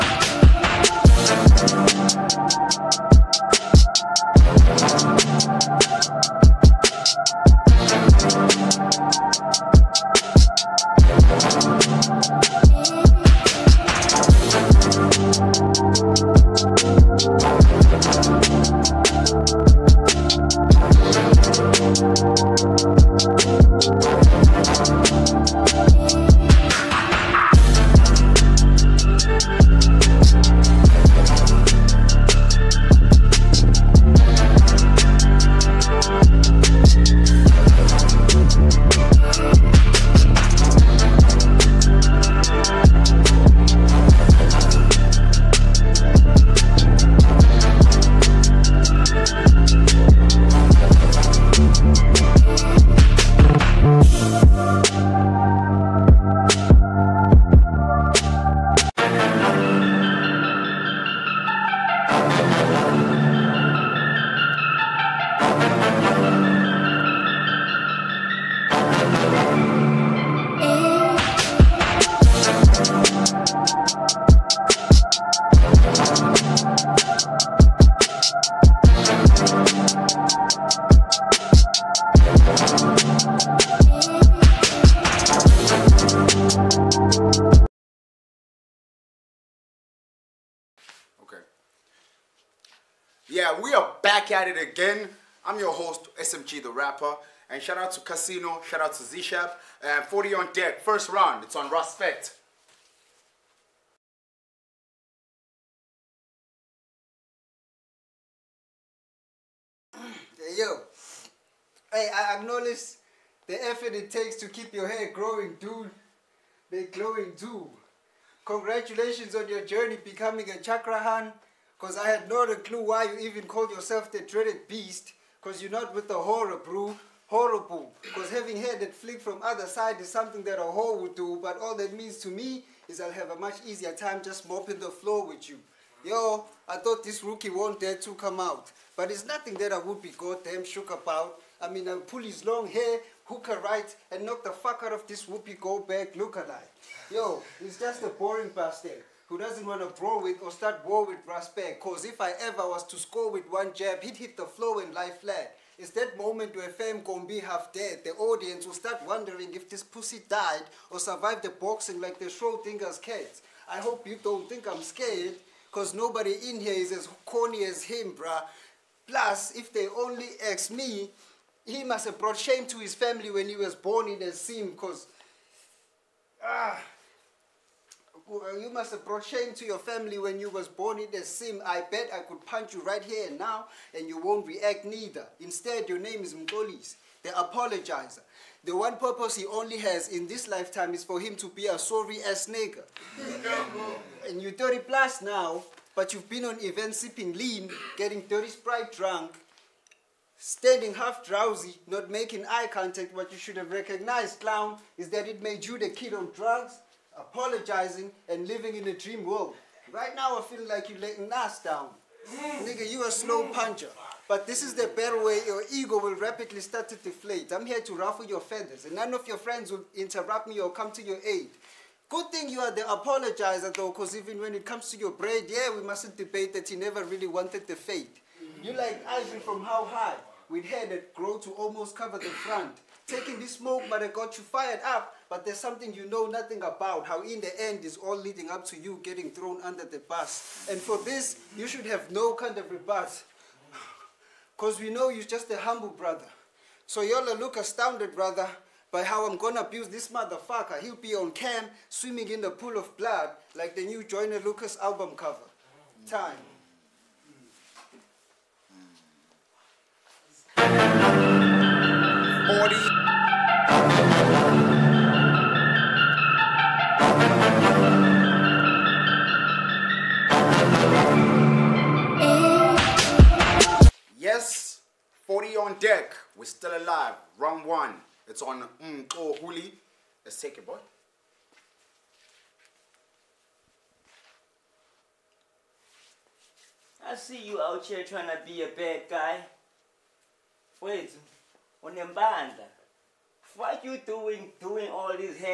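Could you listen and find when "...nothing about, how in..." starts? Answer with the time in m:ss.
3:56.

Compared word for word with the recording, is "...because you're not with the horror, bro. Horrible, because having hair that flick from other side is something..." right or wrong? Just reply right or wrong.
right.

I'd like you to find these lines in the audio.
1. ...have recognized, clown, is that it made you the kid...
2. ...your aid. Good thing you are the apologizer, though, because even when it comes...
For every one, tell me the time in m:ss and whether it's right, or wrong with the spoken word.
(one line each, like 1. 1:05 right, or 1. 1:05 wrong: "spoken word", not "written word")
1. 3:23 right
2. 3:41 right.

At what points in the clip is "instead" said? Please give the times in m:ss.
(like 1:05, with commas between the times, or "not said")
3:05.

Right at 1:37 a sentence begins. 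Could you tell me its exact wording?
And shout out to Khasino, shout out to Zishapp.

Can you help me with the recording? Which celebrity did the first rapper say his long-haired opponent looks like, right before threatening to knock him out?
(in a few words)
Whoopi Goldberg.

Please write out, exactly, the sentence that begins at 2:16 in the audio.
Yo, I thought this rookie won't dare to come out, but it's nothing that I would be goddamn shook about.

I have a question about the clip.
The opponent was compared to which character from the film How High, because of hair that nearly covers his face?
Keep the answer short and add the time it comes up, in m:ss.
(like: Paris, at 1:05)
Ivan, at 3:49.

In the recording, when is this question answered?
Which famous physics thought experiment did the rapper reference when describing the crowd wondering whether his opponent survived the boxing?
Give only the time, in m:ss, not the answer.
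2:42.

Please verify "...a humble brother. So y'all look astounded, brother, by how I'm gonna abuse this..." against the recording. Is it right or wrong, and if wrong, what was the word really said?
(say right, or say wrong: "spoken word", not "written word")
right.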